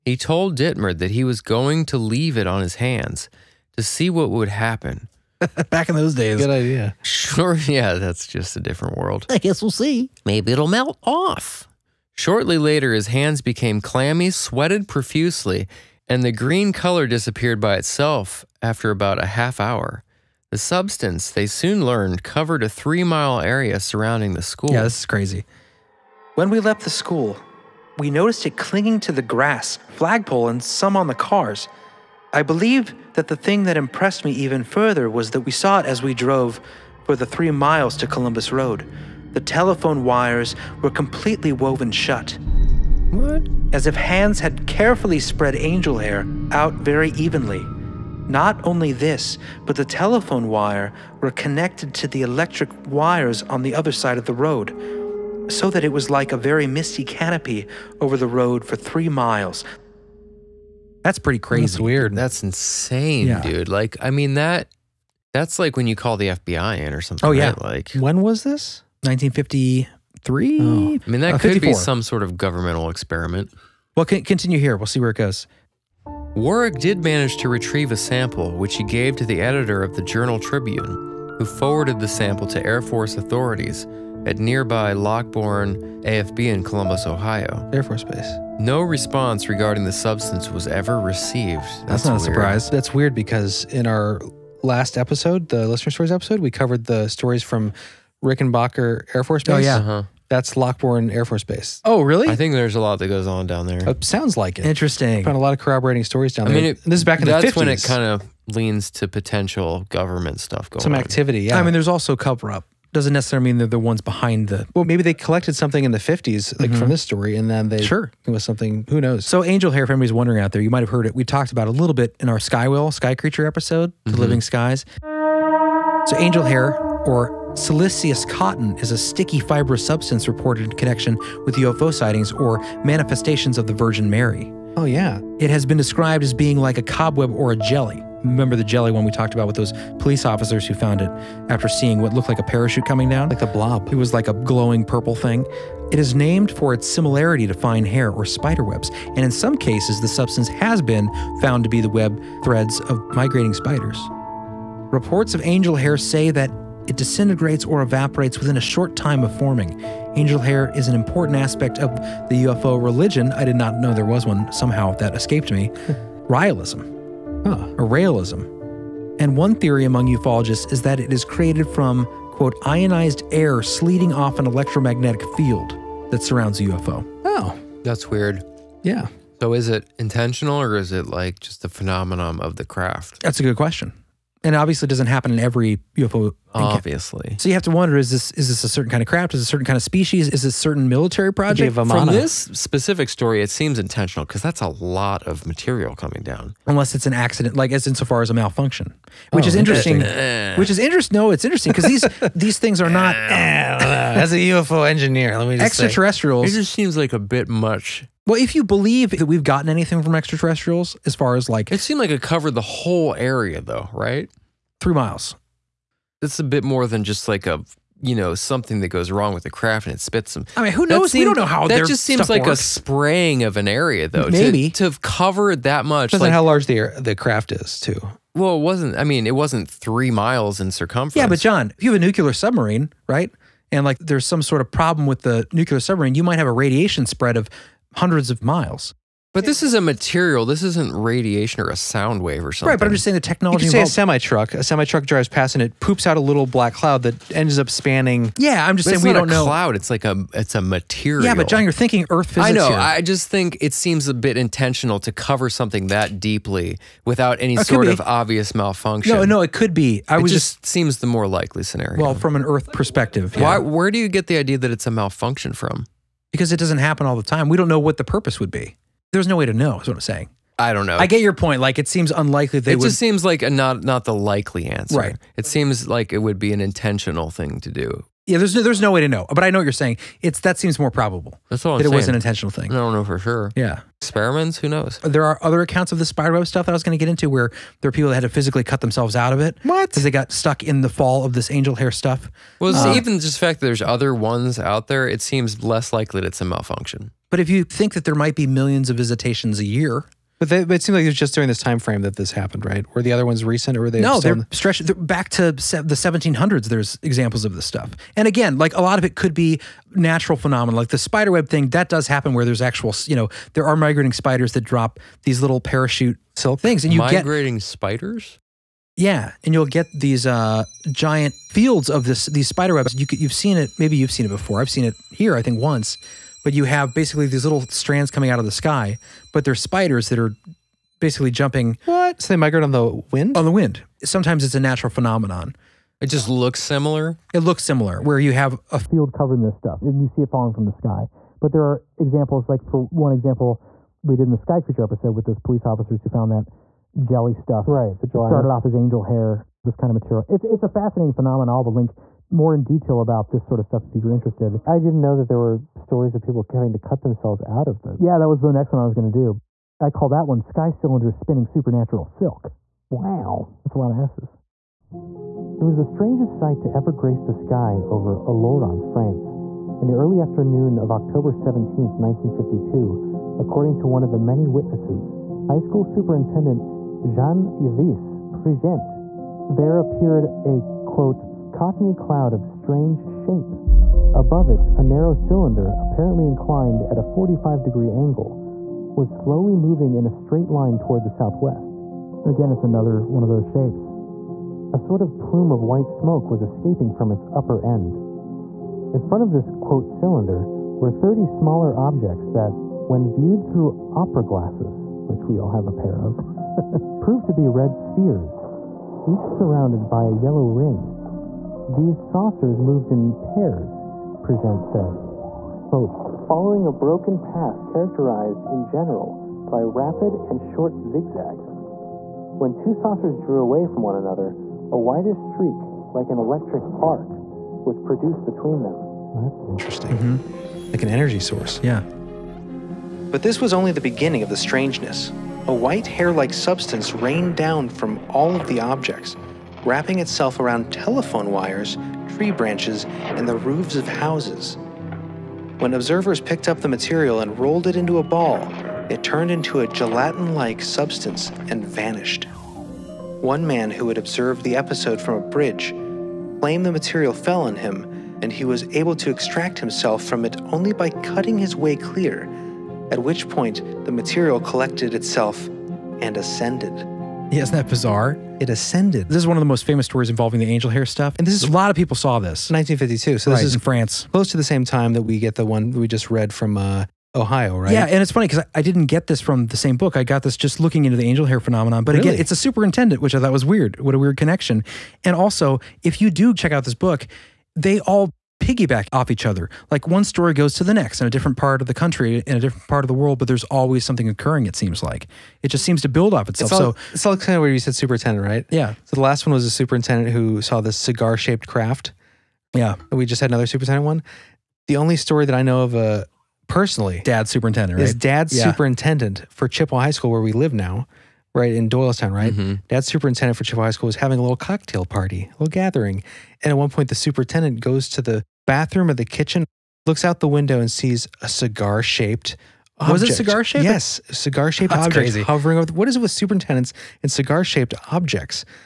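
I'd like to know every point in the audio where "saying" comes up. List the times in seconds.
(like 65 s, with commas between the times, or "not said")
243 s, 248 s, 270 s, 279 s.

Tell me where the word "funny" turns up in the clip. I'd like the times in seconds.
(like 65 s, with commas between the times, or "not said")
478 s.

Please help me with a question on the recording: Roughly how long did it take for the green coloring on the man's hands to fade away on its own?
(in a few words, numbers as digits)
half hour.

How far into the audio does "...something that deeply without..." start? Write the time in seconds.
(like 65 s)
255 s.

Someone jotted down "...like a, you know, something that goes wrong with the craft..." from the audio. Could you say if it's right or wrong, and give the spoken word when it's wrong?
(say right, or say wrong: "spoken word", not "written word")
right.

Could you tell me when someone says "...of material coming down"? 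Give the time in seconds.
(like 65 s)
195 s.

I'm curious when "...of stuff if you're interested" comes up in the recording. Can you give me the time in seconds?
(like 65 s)
353 s.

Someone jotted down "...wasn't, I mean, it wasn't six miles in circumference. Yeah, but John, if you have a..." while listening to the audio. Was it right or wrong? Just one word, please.
wrong.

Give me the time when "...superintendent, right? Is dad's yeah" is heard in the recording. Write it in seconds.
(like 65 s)
507 s.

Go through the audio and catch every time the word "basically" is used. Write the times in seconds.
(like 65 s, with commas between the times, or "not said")
326 s, 331 s.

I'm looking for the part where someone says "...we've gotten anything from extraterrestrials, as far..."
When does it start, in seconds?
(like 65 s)
209 s.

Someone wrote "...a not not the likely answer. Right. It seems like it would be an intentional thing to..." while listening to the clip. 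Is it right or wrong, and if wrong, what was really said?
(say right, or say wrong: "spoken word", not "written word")
right.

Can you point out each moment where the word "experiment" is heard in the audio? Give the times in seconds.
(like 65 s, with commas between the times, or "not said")
72 s, 284 s.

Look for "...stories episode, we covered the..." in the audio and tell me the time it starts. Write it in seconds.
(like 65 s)
95 s.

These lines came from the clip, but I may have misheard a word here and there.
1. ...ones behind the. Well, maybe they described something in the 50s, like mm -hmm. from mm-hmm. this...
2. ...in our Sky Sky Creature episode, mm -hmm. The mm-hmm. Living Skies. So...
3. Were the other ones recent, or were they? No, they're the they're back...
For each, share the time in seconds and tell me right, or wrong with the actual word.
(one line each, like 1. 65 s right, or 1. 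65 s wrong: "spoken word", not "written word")
1. 113 s wrong: "collected", not "described"
2. 122 s right
3. 302 s right.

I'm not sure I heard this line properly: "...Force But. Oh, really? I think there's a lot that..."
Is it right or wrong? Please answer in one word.
wrong.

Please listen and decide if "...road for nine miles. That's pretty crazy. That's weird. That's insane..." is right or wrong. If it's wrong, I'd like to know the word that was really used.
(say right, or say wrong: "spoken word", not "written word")
wrong: "three", not "nine".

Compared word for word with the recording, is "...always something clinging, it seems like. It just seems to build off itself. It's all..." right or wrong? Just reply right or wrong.
wrong.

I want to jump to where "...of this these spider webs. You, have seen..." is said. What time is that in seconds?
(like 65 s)
321 s.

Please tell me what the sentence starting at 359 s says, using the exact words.
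I call that one Sky Cylinder Spinning Supernatural Silk.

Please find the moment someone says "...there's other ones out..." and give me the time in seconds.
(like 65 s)
293 s.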